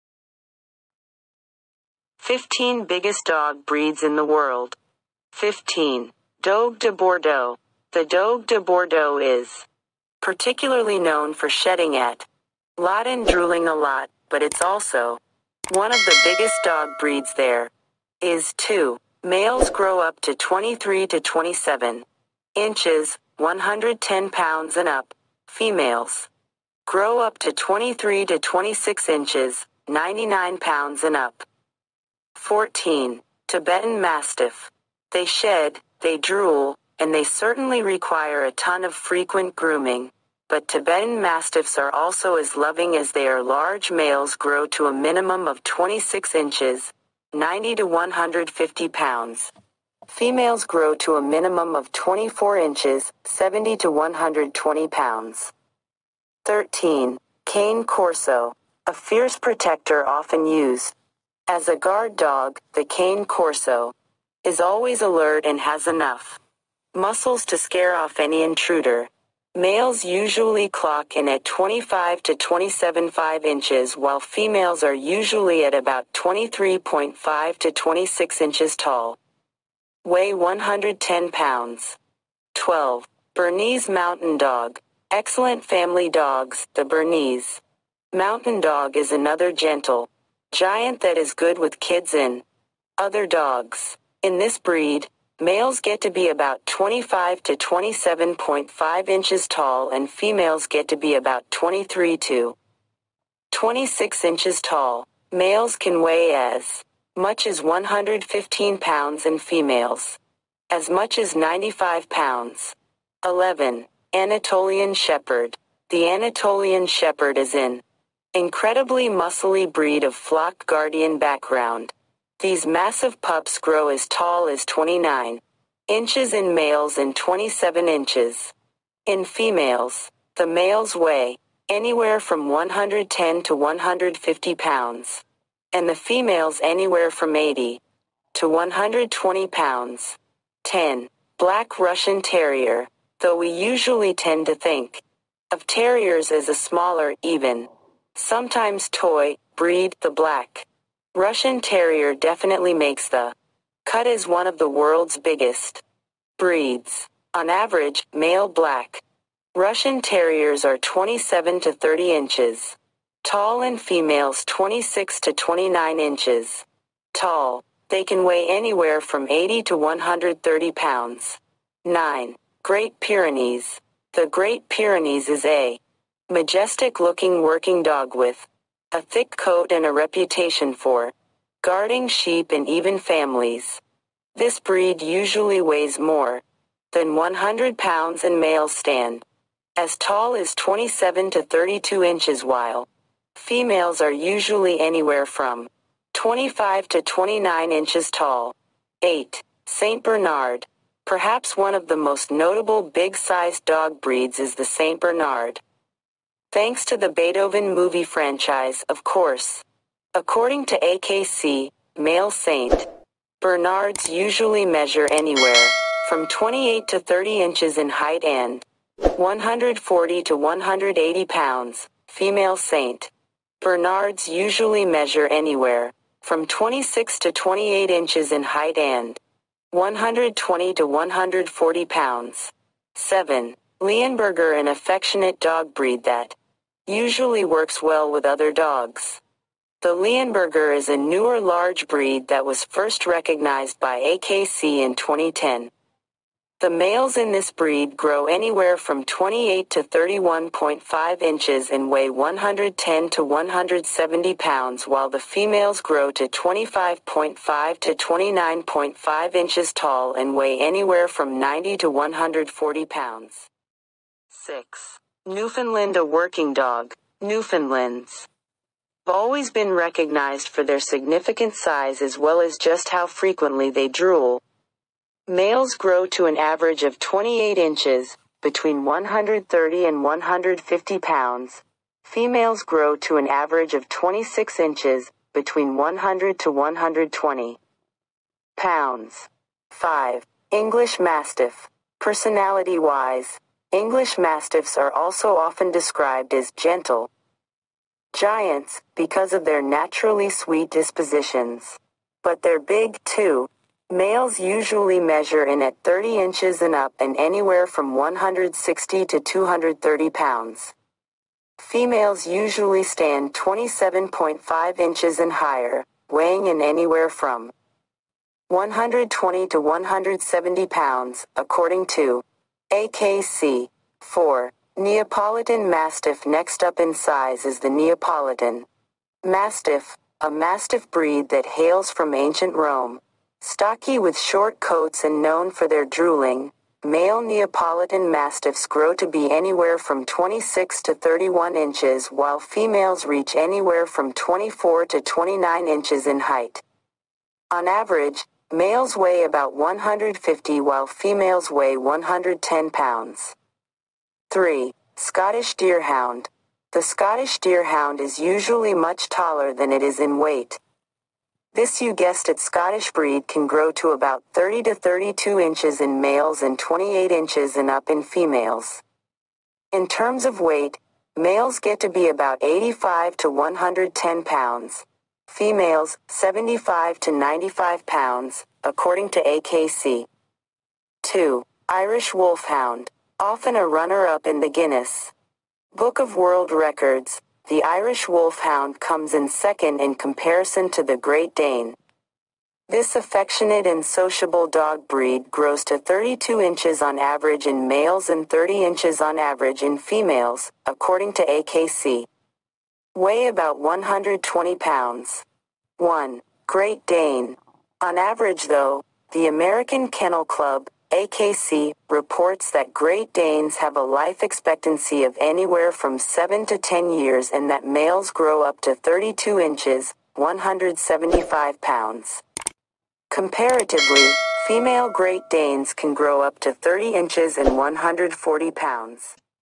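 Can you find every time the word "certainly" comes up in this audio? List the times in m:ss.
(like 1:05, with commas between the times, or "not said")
0:37.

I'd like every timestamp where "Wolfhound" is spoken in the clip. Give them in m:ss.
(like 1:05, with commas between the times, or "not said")
6:22, 6:28.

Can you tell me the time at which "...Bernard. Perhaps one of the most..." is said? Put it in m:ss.
3:20.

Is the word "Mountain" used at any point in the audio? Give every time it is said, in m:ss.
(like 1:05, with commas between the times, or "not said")
1:23, 1:28.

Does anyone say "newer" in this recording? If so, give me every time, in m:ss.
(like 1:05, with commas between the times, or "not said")
4:00.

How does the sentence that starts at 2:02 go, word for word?
These massive pups grow as tall as 29 inches in males and 27 inches in females.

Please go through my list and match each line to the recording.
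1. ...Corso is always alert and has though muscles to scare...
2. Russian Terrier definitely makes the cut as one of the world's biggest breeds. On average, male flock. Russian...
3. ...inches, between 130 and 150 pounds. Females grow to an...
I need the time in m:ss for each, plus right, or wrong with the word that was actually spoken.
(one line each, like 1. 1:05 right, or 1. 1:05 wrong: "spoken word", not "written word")
1. 1:03 wrong: "enough", not "though"
2. 2:31 wrong: "black", not "flock"
3. 4:37 right.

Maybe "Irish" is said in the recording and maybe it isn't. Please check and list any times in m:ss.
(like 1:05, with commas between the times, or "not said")
6:21, 6:27.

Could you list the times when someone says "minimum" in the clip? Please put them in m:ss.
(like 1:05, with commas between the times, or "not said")
0:44, 0:51.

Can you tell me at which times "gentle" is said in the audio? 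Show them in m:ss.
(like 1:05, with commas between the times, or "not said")
1:29, 4:56.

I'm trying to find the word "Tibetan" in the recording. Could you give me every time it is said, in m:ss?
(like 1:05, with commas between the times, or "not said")
0:33, 0:40.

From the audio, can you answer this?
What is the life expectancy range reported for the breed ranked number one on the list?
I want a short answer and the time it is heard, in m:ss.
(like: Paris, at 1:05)
7 to 10 years, at 6:55.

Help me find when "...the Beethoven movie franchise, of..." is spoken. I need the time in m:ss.
3:26.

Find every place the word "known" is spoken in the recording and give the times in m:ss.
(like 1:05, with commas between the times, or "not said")
0:10, 5:35.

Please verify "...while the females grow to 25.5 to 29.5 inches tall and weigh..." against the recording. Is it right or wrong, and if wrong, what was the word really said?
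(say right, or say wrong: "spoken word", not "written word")
right.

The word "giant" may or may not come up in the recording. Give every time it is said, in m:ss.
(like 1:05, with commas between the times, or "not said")
1:30, 4:58.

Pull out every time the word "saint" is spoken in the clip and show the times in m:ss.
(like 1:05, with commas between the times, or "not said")
3:32, 3:42.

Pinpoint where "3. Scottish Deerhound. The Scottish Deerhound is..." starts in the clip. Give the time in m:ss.
5:54.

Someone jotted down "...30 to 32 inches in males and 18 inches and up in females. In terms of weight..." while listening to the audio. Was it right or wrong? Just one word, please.
wrong.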